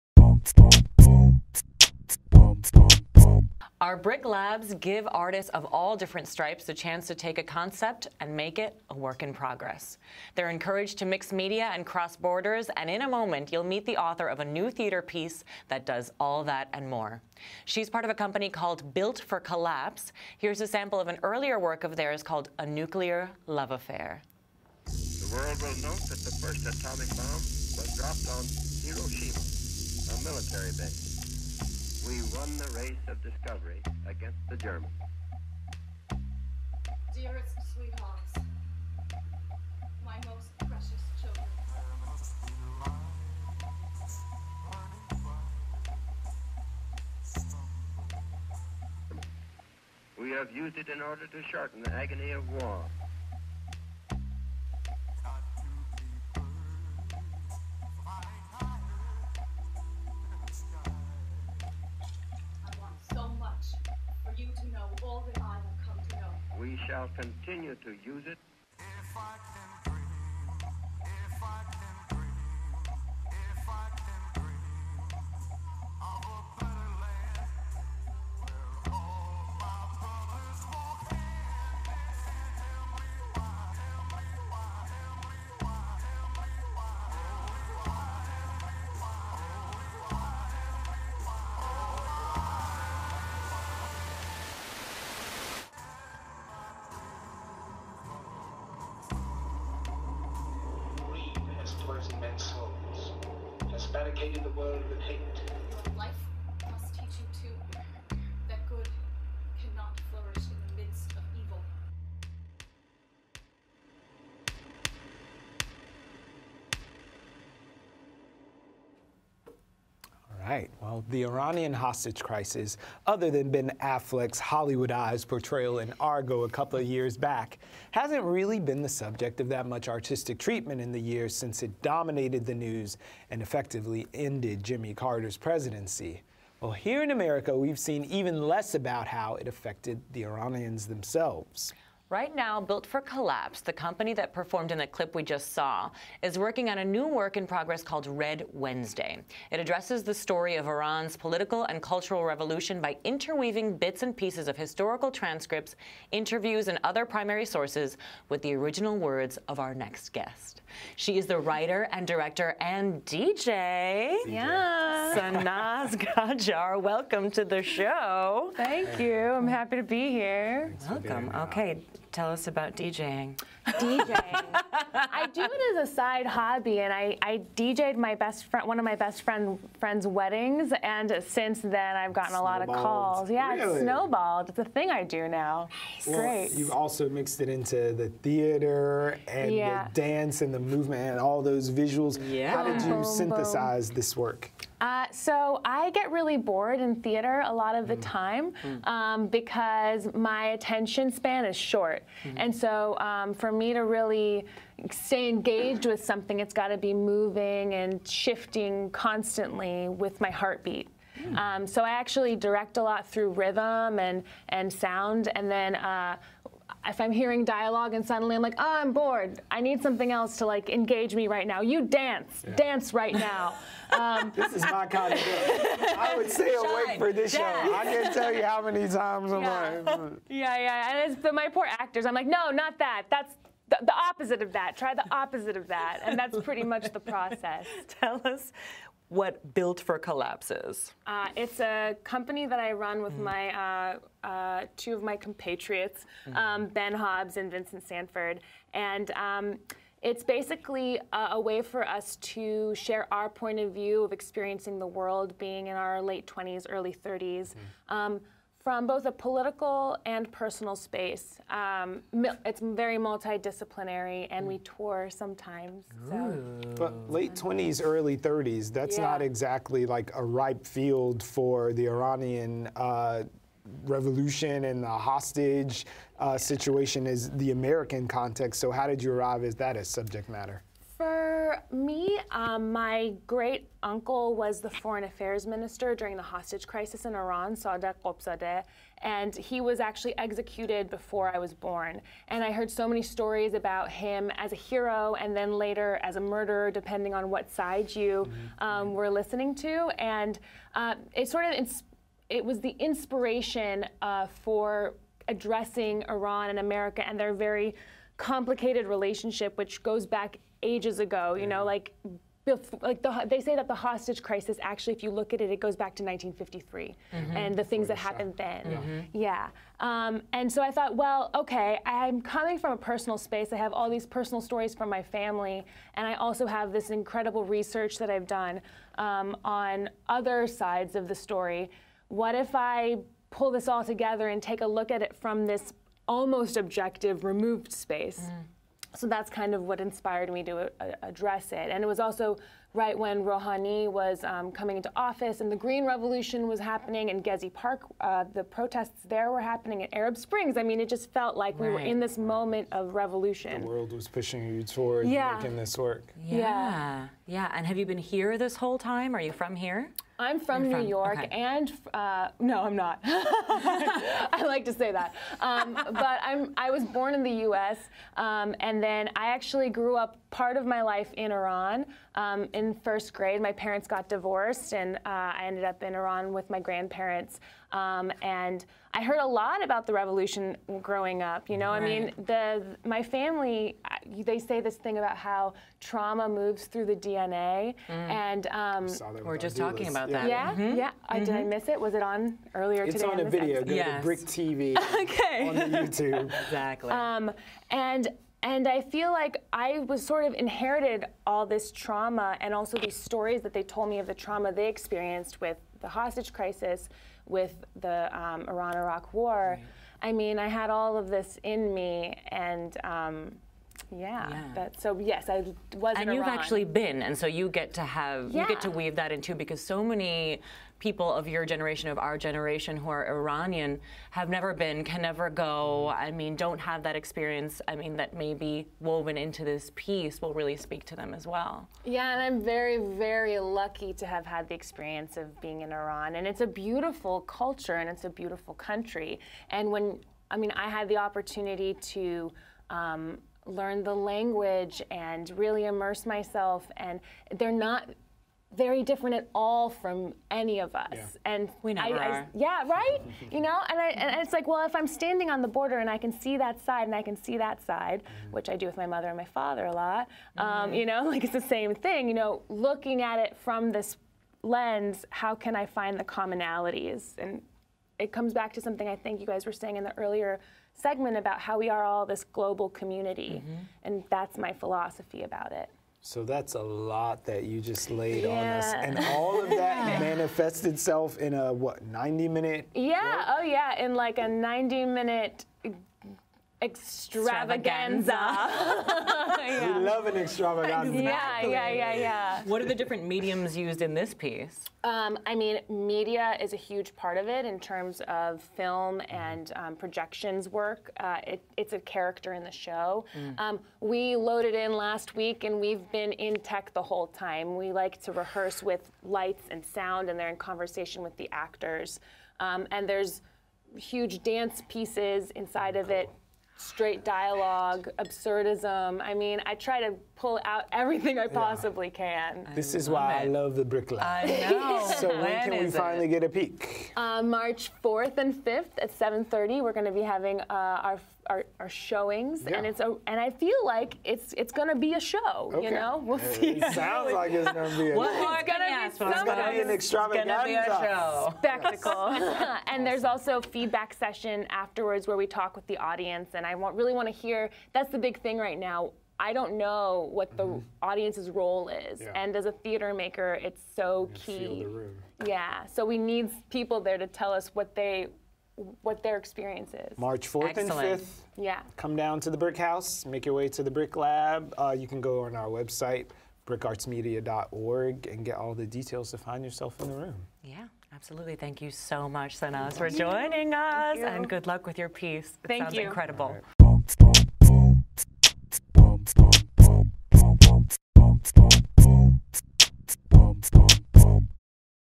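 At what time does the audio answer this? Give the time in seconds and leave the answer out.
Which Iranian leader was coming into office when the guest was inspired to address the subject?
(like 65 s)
343 s.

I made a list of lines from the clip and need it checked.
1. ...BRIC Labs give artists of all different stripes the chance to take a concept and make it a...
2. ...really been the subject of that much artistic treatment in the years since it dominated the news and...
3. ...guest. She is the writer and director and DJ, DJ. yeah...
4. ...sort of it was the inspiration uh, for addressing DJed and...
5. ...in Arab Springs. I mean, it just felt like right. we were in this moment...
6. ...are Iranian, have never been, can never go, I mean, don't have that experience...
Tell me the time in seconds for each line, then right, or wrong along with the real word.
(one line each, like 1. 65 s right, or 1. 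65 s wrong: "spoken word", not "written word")
1. 3 s right
2. 128 s right
3. 160 s right
4. 301 s wrong: "Iran", not "DJed"
5. 349 s right
6. 422 s right.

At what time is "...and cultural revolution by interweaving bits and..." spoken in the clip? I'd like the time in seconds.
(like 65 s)
151 s.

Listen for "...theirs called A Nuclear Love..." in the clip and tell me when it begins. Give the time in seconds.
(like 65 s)
21 s.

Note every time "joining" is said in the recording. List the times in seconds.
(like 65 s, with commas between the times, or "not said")
572 s.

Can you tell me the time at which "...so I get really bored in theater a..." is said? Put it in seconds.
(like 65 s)
195 s.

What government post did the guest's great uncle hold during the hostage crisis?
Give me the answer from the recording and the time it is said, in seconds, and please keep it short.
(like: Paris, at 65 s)
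Foreign affairs minister, at 284 s.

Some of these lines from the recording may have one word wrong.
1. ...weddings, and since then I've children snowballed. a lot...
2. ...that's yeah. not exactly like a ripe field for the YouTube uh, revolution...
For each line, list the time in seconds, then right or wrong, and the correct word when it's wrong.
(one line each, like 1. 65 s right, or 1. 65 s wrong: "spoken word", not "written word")
1. 180 s wrong: "gotten", not "children"
2. 268 s wrong: "Iranian", not "YouTube".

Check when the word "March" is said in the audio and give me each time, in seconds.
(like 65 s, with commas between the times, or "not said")
527 s, 559 s.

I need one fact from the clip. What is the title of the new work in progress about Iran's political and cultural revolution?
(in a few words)
Red Wednesday.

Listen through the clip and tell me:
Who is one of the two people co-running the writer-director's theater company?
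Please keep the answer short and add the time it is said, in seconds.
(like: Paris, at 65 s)
Ben Hobbs, at 246 s.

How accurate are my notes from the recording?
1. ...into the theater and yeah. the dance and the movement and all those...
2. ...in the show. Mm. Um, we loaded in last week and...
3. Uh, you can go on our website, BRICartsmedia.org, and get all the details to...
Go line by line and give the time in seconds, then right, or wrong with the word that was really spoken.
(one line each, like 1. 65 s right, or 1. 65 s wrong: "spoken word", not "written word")
1. 187 s right
2. 502 s right
3. 564 s right.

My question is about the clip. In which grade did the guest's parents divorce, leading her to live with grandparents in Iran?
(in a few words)
First grade.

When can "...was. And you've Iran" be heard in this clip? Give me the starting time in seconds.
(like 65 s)
415 s.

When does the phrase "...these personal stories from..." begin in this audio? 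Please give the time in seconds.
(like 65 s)
323 s.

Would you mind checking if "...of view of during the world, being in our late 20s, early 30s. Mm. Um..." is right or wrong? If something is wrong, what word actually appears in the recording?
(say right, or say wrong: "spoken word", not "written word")
wrong: "experiencing", not "during".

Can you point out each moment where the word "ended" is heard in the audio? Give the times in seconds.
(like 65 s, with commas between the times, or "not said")
134 s, 375 s.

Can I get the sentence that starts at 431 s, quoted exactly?
Yeah, and I'm very, very lucky to have had the experience of being in Iran.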